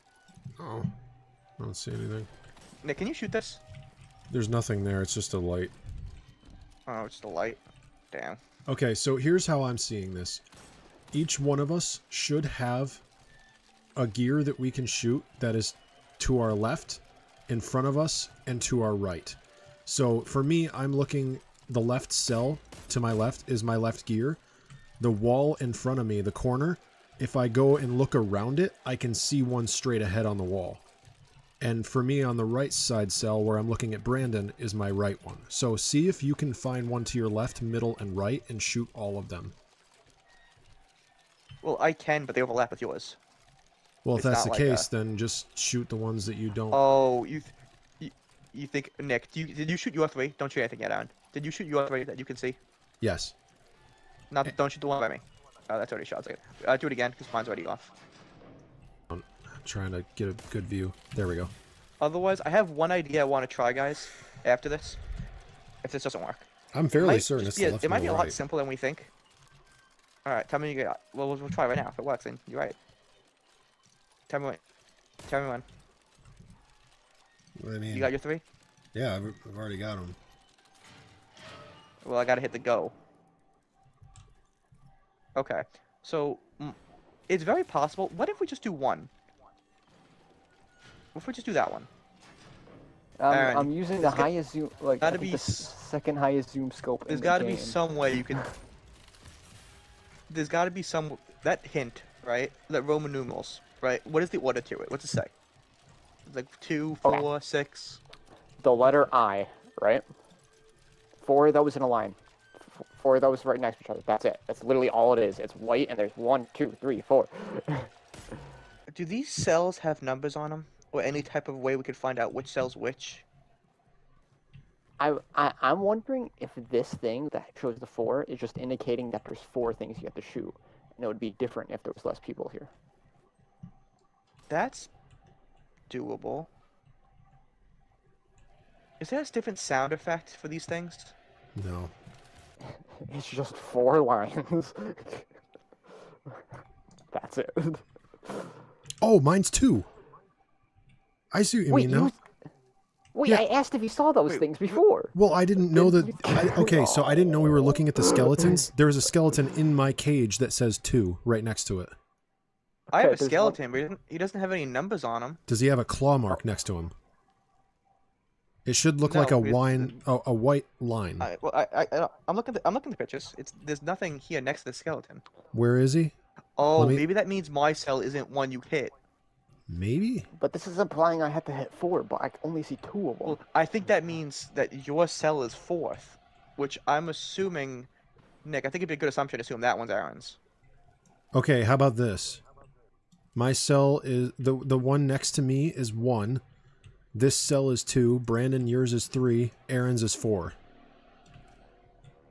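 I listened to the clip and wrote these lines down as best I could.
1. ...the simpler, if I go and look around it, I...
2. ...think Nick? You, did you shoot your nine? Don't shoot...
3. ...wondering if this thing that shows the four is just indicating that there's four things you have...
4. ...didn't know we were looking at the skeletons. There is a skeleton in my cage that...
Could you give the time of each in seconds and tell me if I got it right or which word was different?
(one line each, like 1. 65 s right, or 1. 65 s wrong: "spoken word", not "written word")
1. 26 s wrong: "corner", not "simpler"
2. 48 s wrong: "three", not "nine"
3. 125 s right
4. 157 s right.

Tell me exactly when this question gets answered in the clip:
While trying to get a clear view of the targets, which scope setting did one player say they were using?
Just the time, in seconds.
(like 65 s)
95 s.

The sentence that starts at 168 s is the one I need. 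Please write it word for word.
It should look no, like a wine, a, a, white line.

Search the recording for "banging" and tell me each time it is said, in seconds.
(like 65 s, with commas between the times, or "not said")
not said.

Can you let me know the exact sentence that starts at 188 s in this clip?
I think it'd be a good assumption to assume that one's Aaron's.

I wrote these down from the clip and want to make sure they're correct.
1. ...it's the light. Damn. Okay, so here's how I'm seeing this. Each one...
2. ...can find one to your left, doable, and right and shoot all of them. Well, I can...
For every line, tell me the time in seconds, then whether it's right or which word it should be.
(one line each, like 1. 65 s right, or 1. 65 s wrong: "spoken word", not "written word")
1. 7 s right
2. 36 s wrong: "middle", not "doable".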